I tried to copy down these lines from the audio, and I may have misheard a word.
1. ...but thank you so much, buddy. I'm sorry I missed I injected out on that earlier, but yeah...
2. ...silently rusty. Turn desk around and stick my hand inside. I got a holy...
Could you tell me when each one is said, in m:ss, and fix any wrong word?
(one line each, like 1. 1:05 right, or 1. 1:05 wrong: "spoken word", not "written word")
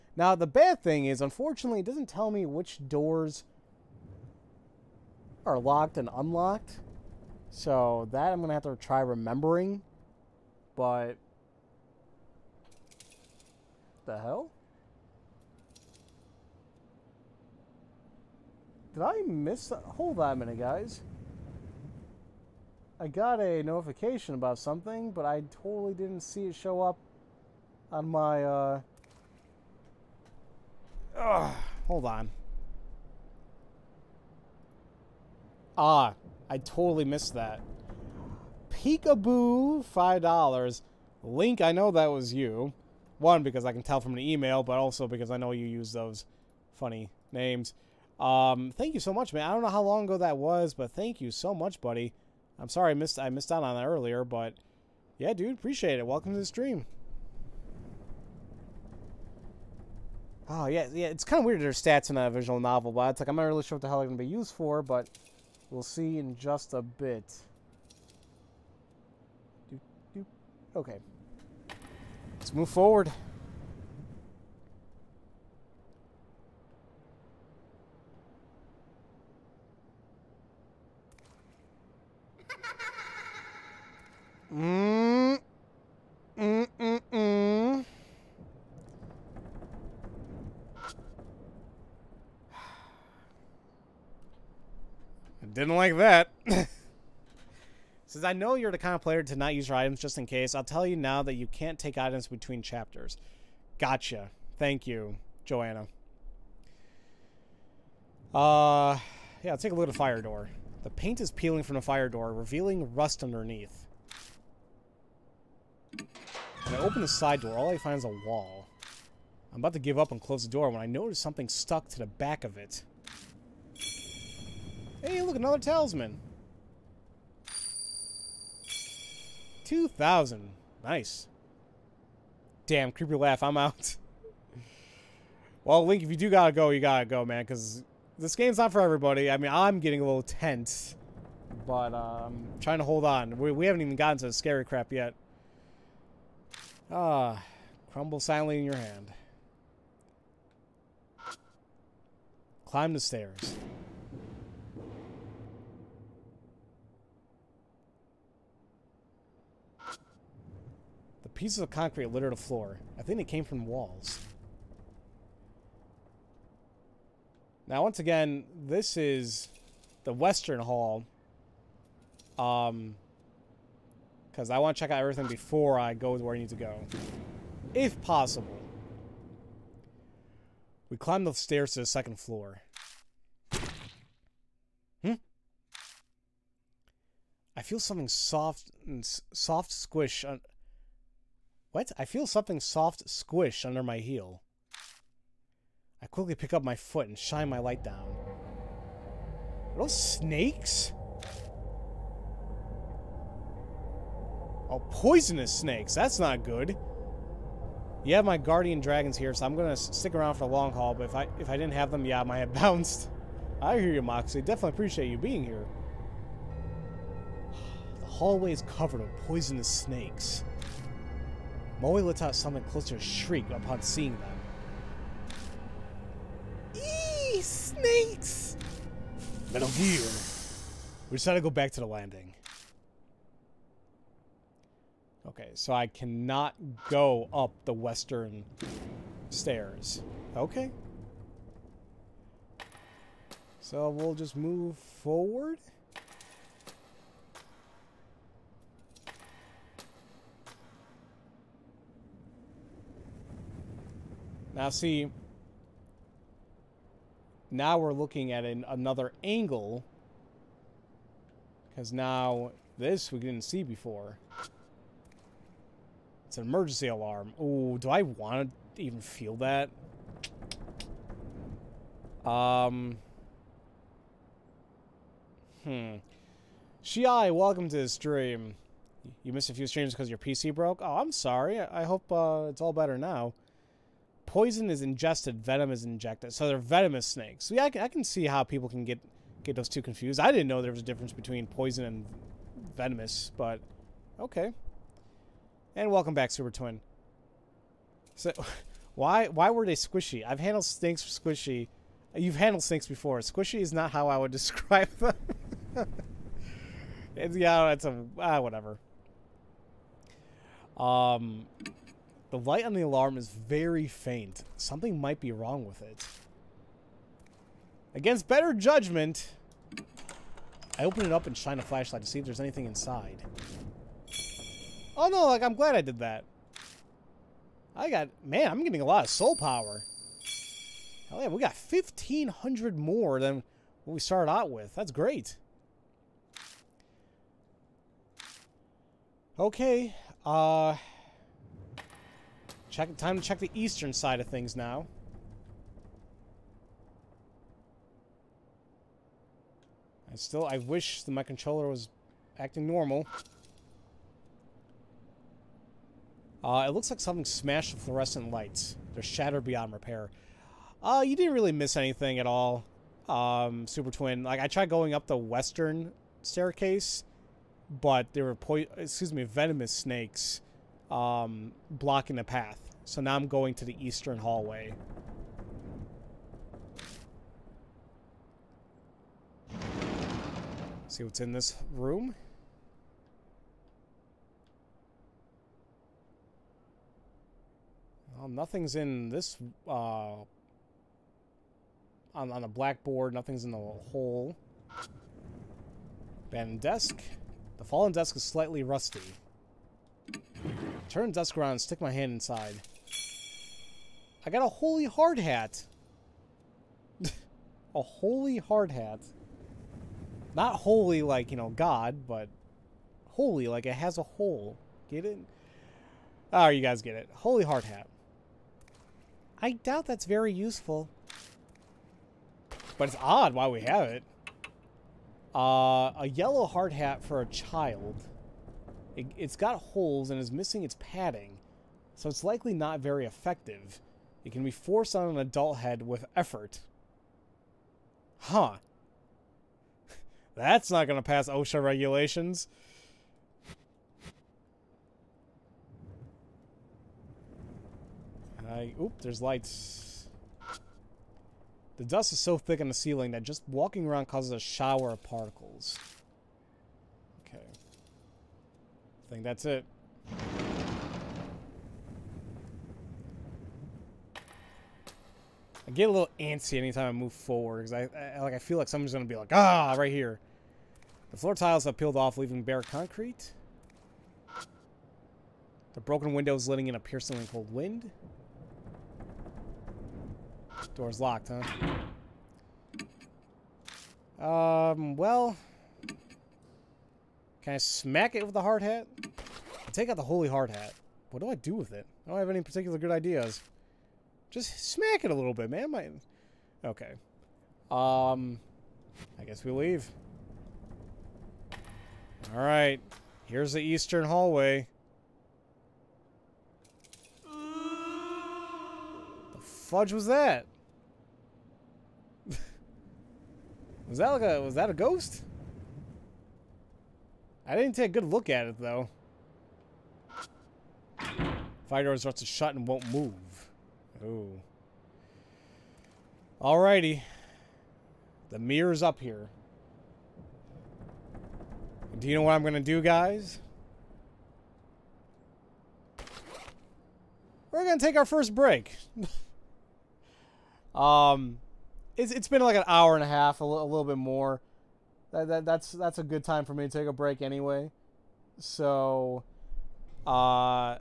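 1. 0:50 wrong: "missed", not "injected"
2. 6:38 wrong: "slightly", not "silently".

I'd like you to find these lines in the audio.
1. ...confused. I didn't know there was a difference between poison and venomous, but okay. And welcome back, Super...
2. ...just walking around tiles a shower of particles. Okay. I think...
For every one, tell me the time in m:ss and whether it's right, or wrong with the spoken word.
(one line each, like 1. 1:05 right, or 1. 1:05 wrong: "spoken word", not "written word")
1. 4:49 right
2. 7:33 wrong: "causes", not "tiles".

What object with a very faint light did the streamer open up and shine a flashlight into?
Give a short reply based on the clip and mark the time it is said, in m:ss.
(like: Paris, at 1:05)
emergency alarm, at 4:26.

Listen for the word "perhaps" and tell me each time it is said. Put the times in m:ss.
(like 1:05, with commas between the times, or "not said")
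not said.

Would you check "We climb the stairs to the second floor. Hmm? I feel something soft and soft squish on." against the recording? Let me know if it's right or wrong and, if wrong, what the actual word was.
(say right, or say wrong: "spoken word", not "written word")
right.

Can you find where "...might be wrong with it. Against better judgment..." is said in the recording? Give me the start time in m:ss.
5:14.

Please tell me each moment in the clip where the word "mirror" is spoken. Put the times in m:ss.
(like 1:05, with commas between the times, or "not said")
8:48.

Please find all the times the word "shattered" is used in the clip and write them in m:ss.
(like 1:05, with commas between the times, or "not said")
5:59.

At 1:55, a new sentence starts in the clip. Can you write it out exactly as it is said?
When I open the side door, all I find is a wall.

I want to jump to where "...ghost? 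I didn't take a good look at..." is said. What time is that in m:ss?
8:34.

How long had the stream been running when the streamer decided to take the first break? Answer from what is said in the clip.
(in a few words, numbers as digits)
an hour and a half.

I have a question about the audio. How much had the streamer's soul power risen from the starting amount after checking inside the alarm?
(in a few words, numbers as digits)
1,500.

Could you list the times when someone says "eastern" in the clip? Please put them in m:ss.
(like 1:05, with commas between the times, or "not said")
5:43, 6:13, 8:23.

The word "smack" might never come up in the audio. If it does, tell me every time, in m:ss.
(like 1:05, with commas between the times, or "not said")
8:07, 8:14.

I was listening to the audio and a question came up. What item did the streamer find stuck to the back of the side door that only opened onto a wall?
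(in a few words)
talisman.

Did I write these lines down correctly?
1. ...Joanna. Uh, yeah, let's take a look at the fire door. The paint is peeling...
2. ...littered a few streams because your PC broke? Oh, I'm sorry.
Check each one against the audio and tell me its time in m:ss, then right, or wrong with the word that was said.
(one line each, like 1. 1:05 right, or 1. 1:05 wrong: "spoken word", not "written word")
1. 1:45 right
2. 4:39 wrong: "missed", not "littered".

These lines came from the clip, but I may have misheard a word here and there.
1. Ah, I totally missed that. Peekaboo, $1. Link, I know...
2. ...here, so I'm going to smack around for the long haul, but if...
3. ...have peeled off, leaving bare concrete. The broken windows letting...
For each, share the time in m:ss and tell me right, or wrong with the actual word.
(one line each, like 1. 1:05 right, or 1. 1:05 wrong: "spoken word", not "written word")
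1. 0:35 wrong: "5", not "1"
2. 3:29 wrong: "stick", not "smack"
3. 7:51 right.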